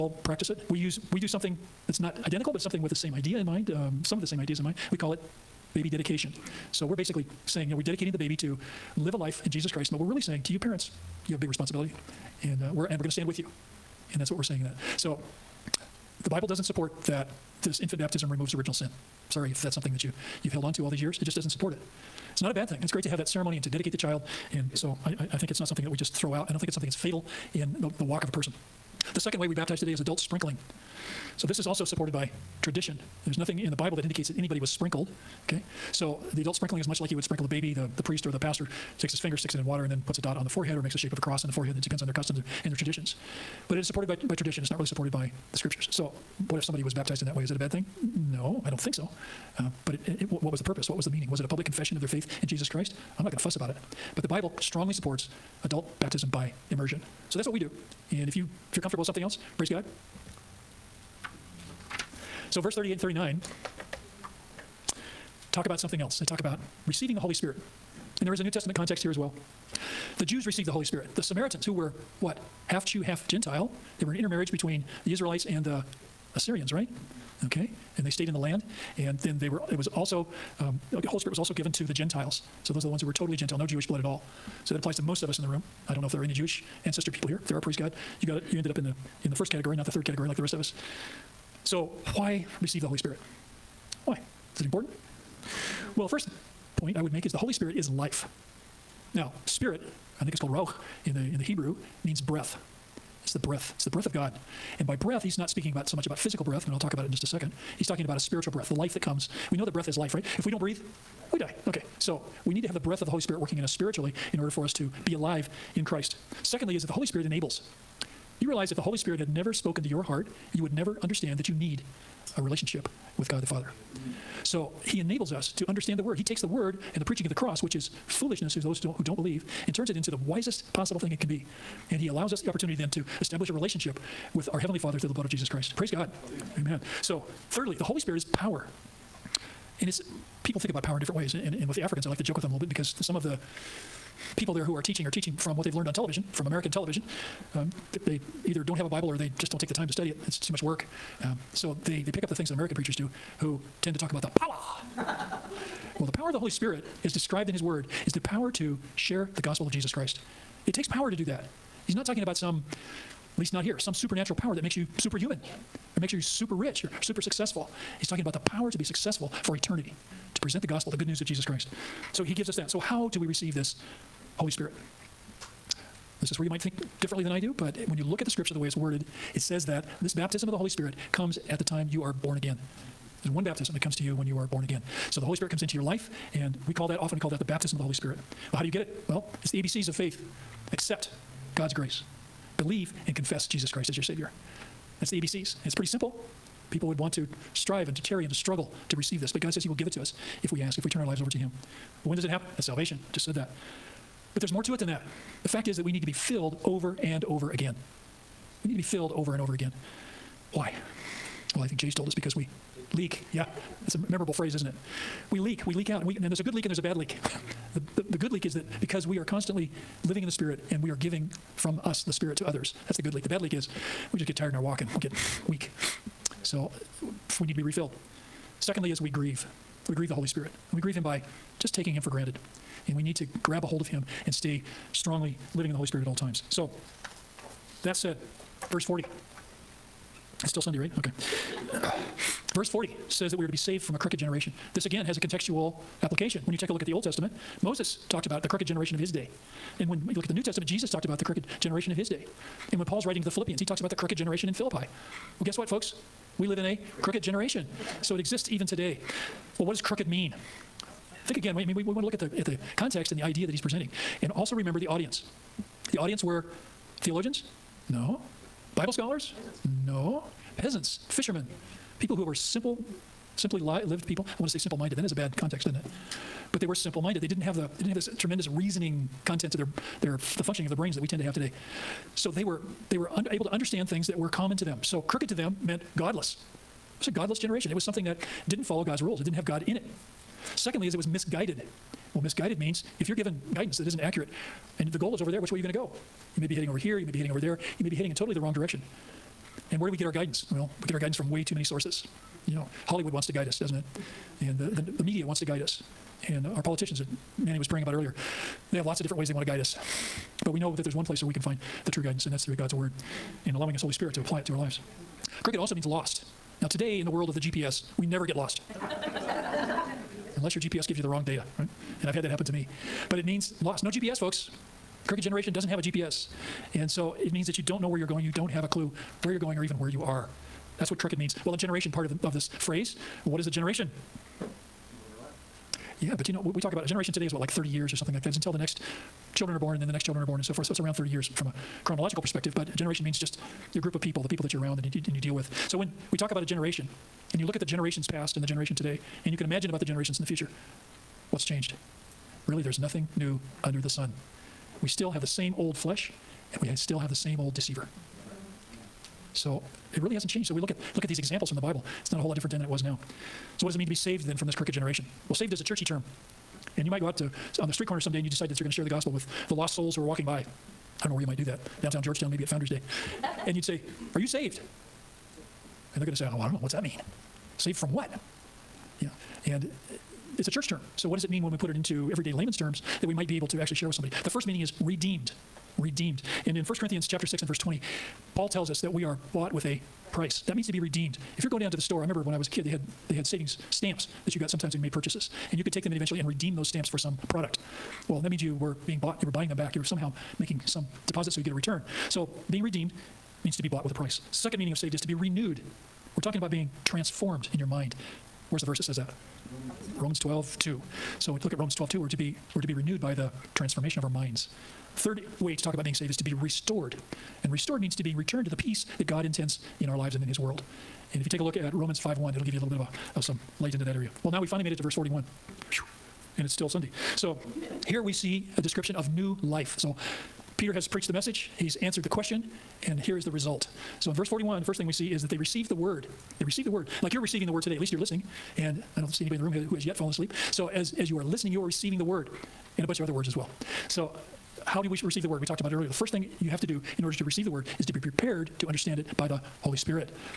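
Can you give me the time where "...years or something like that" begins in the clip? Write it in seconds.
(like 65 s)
337 s.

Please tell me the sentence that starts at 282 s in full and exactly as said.
So they were they were able to understand things that were common to them.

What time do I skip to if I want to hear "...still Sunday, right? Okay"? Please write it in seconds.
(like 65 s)
240 s.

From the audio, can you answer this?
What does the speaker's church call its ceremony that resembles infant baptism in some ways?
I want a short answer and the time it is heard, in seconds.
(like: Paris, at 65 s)
Baby dedication, at 5 s.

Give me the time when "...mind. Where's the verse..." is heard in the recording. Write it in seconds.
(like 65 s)
407 s.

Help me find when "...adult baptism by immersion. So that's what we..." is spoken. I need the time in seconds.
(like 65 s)
55 s.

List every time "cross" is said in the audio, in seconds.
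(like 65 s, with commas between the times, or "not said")
41 s, 127 s.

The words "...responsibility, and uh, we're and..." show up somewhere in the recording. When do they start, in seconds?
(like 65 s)
11 s.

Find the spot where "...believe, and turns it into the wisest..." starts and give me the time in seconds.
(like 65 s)
129 s.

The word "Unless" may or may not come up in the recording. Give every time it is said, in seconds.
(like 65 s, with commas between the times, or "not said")
320 s.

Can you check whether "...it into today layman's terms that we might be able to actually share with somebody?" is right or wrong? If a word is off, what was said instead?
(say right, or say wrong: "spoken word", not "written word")
wrong: "everyday", not "today".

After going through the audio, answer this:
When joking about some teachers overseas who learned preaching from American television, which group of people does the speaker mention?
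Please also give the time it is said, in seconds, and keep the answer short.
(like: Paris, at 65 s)
The Africans, at 141 s.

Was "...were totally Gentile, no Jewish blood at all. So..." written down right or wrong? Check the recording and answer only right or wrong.
right.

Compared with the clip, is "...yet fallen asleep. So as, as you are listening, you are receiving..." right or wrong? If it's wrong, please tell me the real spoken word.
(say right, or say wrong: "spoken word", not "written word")
right.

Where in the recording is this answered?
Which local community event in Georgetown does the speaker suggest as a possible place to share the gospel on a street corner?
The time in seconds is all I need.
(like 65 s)
372 s.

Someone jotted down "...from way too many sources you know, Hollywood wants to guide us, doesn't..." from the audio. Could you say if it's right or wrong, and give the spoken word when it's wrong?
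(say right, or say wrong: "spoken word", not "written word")
right.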